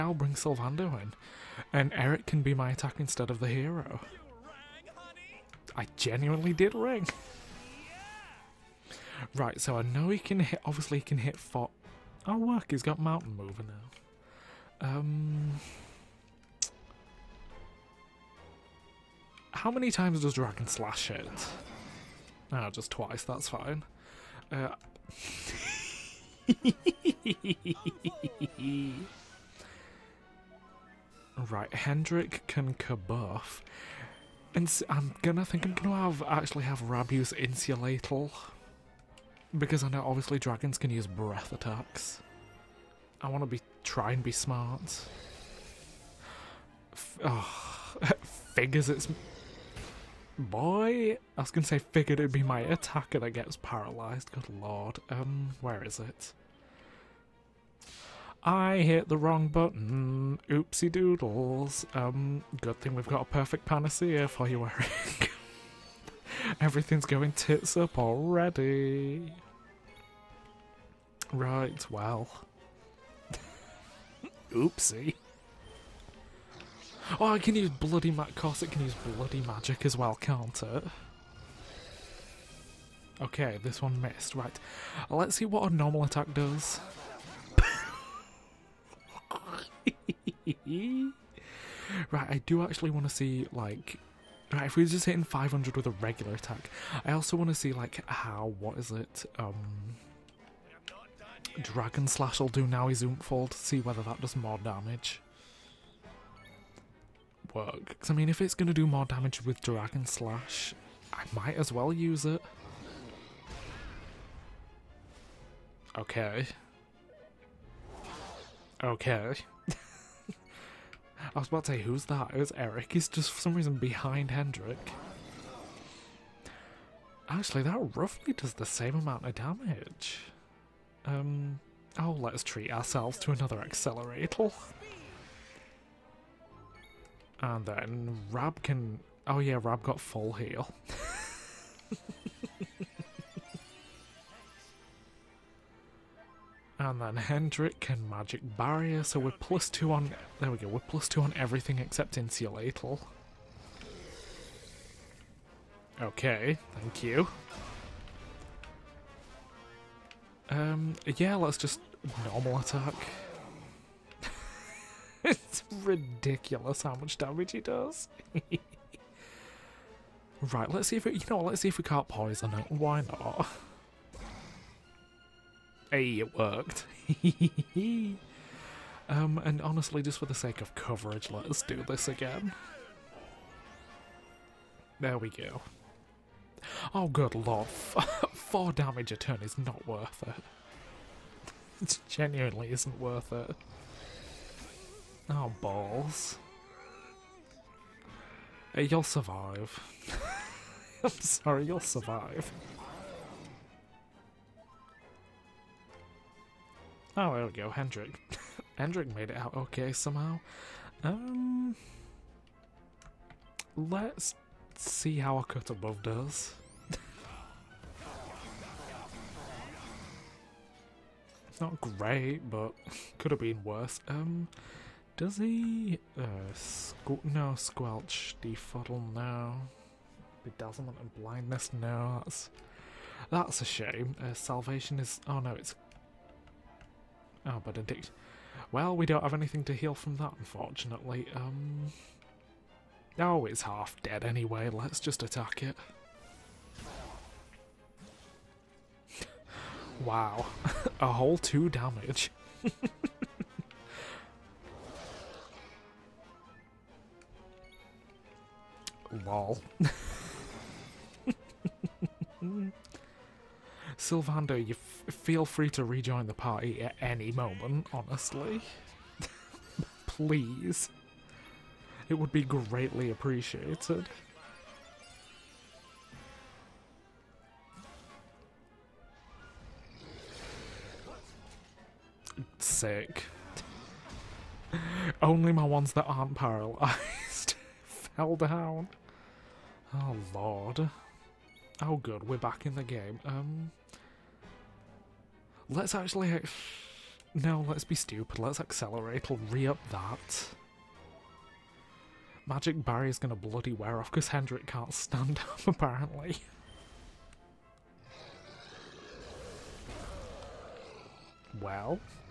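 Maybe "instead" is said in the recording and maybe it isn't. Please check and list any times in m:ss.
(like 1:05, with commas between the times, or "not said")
0:03.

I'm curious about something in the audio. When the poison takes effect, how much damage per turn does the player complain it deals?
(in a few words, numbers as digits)
4.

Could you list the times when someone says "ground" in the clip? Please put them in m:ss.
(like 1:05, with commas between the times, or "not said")
not said.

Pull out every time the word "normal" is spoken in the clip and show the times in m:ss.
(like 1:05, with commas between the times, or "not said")
1:25, 2:42.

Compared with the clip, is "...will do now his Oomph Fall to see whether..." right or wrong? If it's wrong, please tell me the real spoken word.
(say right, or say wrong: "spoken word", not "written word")
right.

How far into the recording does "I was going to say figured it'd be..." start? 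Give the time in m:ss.
0:51.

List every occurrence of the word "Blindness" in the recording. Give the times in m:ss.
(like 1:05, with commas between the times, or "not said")
3:51.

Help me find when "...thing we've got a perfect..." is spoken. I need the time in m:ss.
1:02.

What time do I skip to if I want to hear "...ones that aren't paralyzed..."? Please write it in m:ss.
4:45.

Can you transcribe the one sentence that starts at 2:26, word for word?
and then Hendrik can magic barrier, so we're plus two on...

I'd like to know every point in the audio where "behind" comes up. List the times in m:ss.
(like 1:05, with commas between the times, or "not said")
2:03.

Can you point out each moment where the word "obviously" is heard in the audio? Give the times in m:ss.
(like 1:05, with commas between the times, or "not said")
0:10, 0:40.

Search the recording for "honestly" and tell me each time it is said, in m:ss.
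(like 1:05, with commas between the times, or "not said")
2:59, 4:27.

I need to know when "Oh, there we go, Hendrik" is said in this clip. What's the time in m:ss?
3:27.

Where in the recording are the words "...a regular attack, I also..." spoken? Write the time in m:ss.
1:35.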